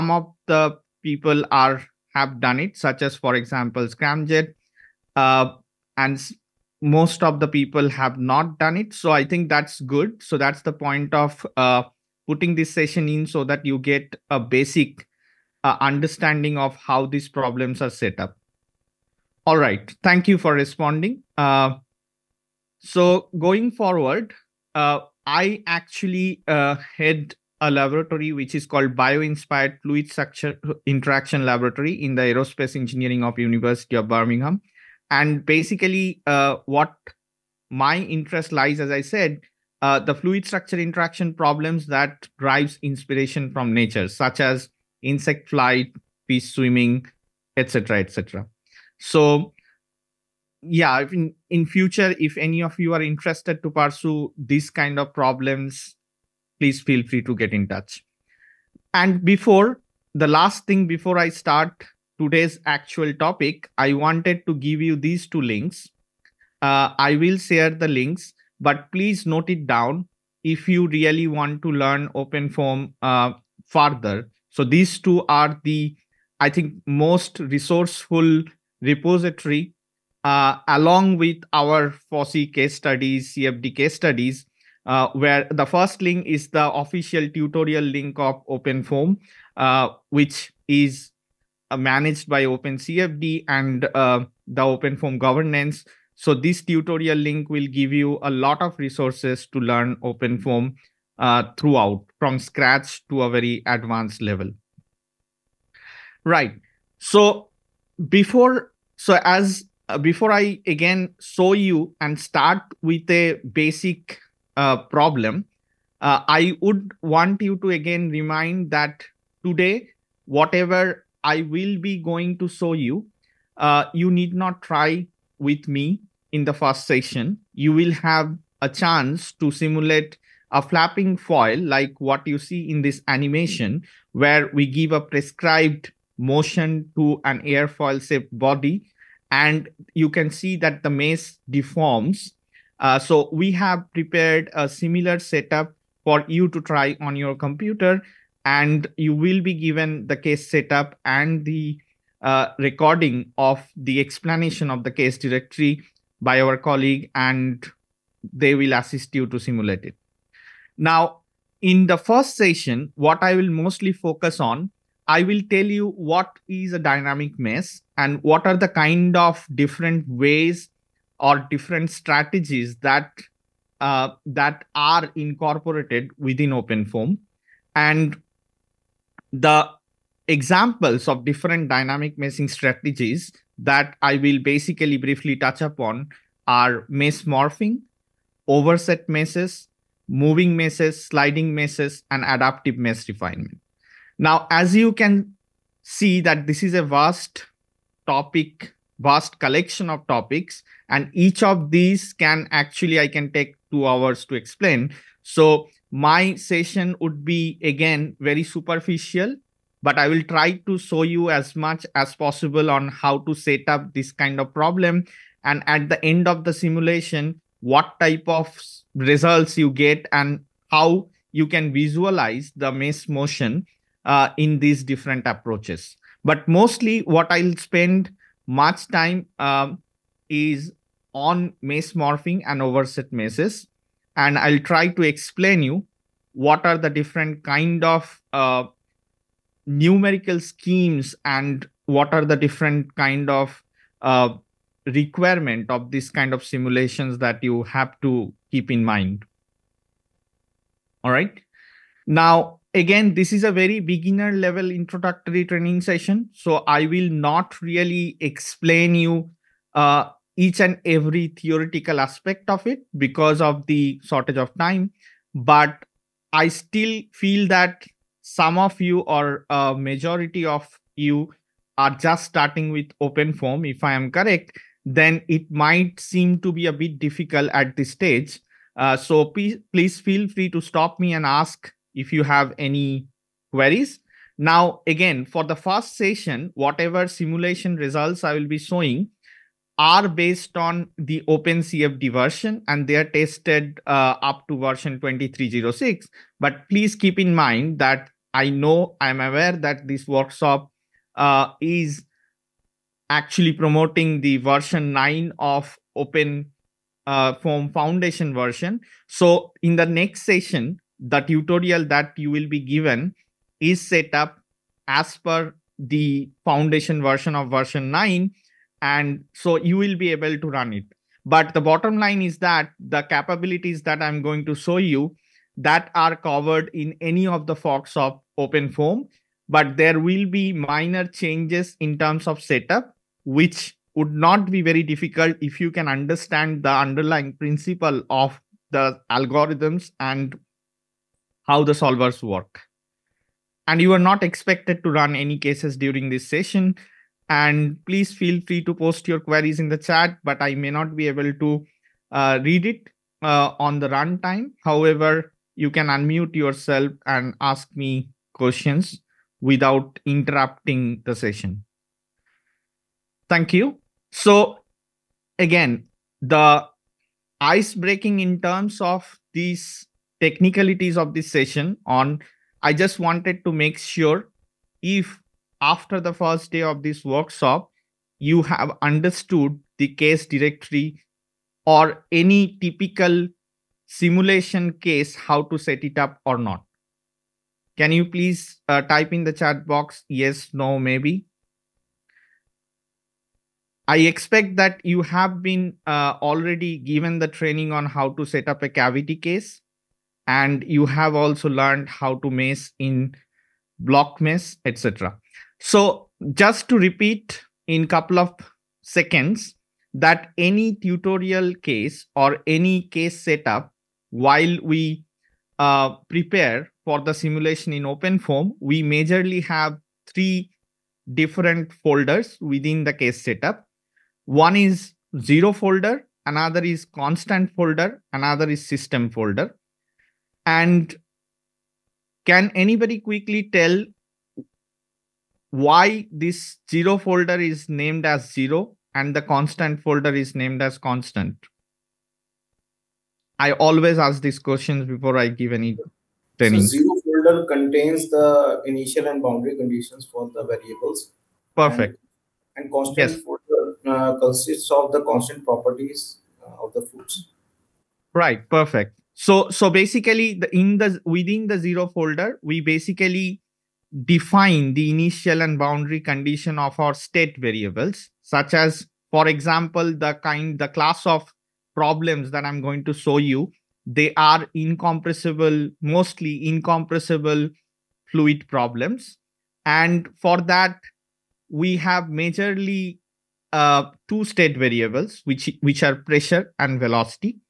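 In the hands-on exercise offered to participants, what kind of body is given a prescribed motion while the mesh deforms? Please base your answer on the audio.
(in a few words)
A flapping foil.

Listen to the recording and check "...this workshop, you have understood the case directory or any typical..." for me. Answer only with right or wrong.
right.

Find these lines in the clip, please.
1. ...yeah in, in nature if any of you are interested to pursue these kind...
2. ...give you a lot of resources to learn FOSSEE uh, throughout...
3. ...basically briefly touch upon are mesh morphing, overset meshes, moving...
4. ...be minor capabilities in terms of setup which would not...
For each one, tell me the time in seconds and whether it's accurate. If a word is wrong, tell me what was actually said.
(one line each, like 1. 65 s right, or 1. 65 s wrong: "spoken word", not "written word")
1. 50 s wrong: "future", not "nature"
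2. 97 s wrong: "OpenFOAM", not "FOSSEE"
3. 184 s right
4. 330 s wrong: "changes", not "capabilities".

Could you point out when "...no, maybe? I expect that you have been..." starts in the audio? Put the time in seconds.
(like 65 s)
390 s.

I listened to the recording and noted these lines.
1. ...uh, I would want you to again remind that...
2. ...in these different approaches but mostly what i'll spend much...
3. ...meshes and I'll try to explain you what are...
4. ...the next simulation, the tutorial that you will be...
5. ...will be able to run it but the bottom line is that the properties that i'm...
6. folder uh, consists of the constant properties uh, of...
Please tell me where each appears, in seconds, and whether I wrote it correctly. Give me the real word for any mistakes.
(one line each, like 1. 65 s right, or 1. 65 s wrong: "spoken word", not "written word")
1. 116 s right
2. 224 s right
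3. 233 s right
4. 309 s wrong: "session", not "simulation"
5. 319 s wrong: "capabilities", not "properties"
6. 453 s right.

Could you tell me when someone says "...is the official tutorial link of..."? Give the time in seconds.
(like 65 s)
86 s.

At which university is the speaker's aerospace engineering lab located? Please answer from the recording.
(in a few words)
University of Birmingham.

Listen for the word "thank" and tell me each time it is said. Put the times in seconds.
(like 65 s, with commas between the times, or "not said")
20 s, 363 s.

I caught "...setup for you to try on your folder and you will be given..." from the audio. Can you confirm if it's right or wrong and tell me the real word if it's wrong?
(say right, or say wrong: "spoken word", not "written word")
wrong: "computer", not "folder".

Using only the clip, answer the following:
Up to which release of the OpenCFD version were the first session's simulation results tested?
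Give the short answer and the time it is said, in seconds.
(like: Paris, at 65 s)
2306, at 294 s.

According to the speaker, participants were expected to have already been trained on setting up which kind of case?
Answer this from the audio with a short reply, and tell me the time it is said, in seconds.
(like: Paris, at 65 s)
A cavity case, at 398 s.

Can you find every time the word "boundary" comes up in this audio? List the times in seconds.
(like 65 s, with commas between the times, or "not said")
449 s, 465 s.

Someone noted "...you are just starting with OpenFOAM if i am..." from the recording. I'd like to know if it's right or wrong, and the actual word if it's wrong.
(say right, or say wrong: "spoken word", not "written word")
right.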